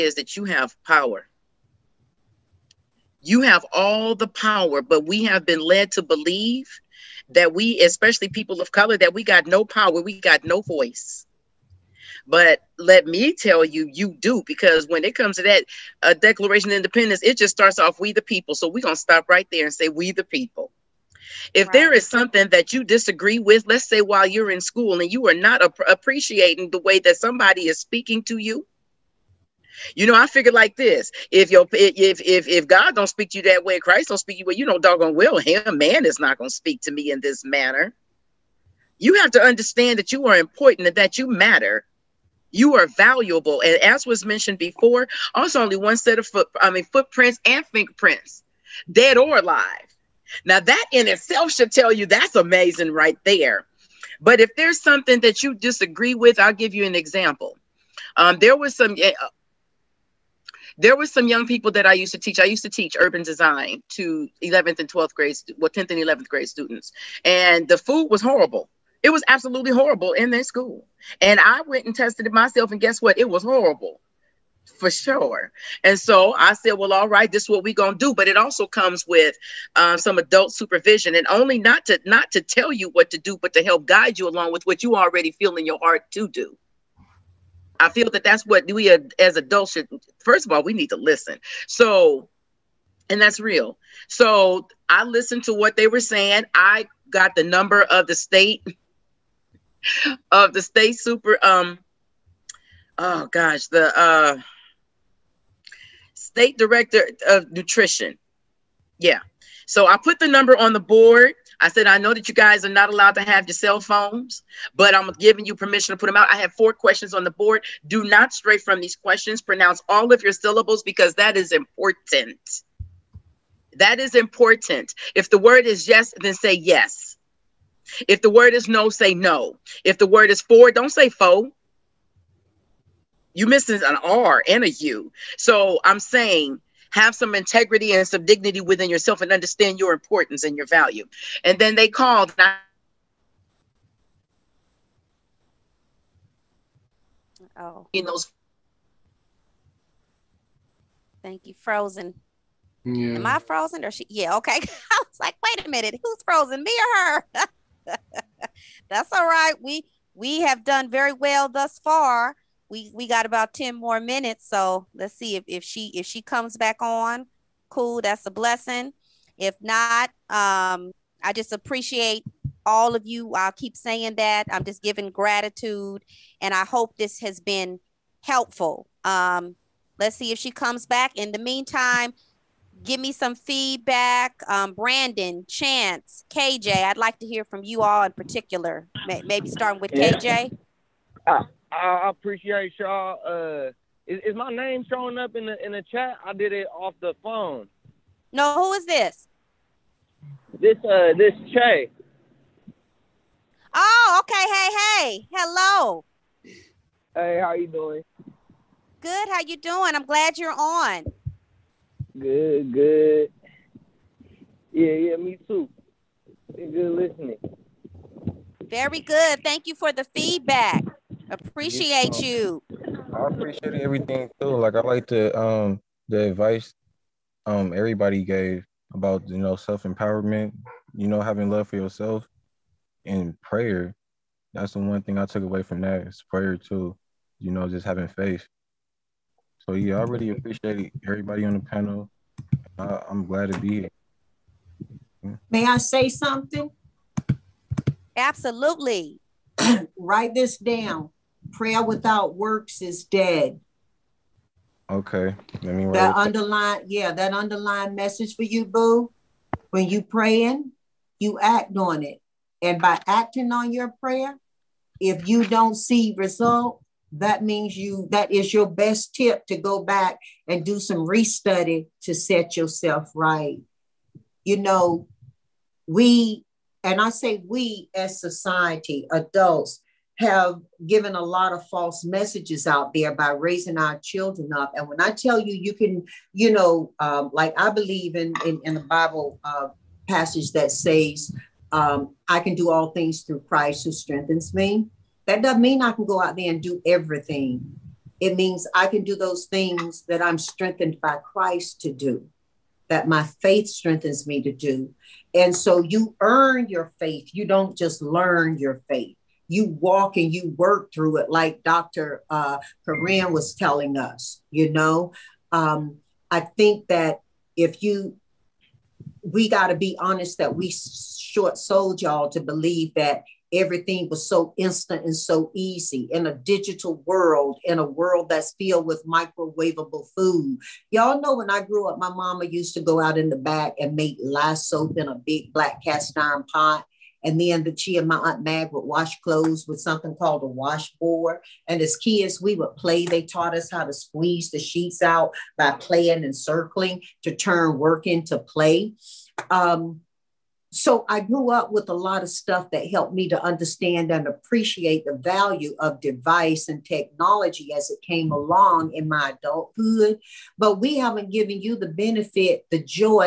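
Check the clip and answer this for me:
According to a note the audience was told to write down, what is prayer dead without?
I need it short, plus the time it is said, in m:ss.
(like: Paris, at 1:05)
works, at 4:12.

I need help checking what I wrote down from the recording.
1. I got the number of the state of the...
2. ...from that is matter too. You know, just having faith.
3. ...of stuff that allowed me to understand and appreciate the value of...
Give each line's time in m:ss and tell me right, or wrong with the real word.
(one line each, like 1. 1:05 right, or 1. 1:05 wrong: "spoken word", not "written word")
1. 1:36 right
2. 3:55 wrong: "prayer", not "matter"
3. 5:52 wrong: "helped", not "allowed".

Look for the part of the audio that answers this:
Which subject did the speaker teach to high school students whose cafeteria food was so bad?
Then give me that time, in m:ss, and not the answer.
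1:02.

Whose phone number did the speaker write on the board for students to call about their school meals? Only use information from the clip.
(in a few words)
state director of nutrition.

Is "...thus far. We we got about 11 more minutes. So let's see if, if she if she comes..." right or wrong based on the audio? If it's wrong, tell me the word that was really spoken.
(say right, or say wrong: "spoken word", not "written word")
wrong: "10", not "11".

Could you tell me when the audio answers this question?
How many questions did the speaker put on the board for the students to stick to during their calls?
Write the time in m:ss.
1:56.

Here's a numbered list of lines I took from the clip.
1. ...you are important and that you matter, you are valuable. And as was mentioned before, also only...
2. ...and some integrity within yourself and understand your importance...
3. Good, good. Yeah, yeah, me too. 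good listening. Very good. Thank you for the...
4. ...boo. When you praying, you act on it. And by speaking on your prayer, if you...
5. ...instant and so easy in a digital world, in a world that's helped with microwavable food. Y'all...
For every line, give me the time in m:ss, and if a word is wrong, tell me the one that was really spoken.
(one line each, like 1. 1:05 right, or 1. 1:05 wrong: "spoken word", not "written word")
1. 0:40 right
2. 2:17 wrong: "dignity", not "integrity"
3. 3:32 right
4. 4:18 wrong: "acting", not "speaking"
5. 5:24 wrong: "filled", not "helped".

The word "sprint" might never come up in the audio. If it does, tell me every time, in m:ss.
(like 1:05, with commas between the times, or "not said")
not said.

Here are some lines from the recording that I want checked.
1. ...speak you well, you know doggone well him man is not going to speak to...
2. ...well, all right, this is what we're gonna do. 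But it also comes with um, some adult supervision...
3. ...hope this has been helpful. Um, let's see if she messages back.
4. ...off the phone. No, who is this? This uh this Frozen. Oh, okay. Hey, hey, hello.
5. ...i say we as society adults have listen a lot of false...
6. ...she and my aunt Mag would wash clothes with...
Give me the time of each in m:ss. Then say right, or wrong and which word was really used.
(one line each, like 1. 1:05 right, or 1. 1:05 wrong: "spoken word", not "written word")
1. 0:34 right
2. 1:16 right
3. 2:56 wrong: "comes", not "messages"
4. 3:16 wrong: "Che", not "Frozen"
5. 4:37 wrong: "given", not "listen"
6. 5:37 right.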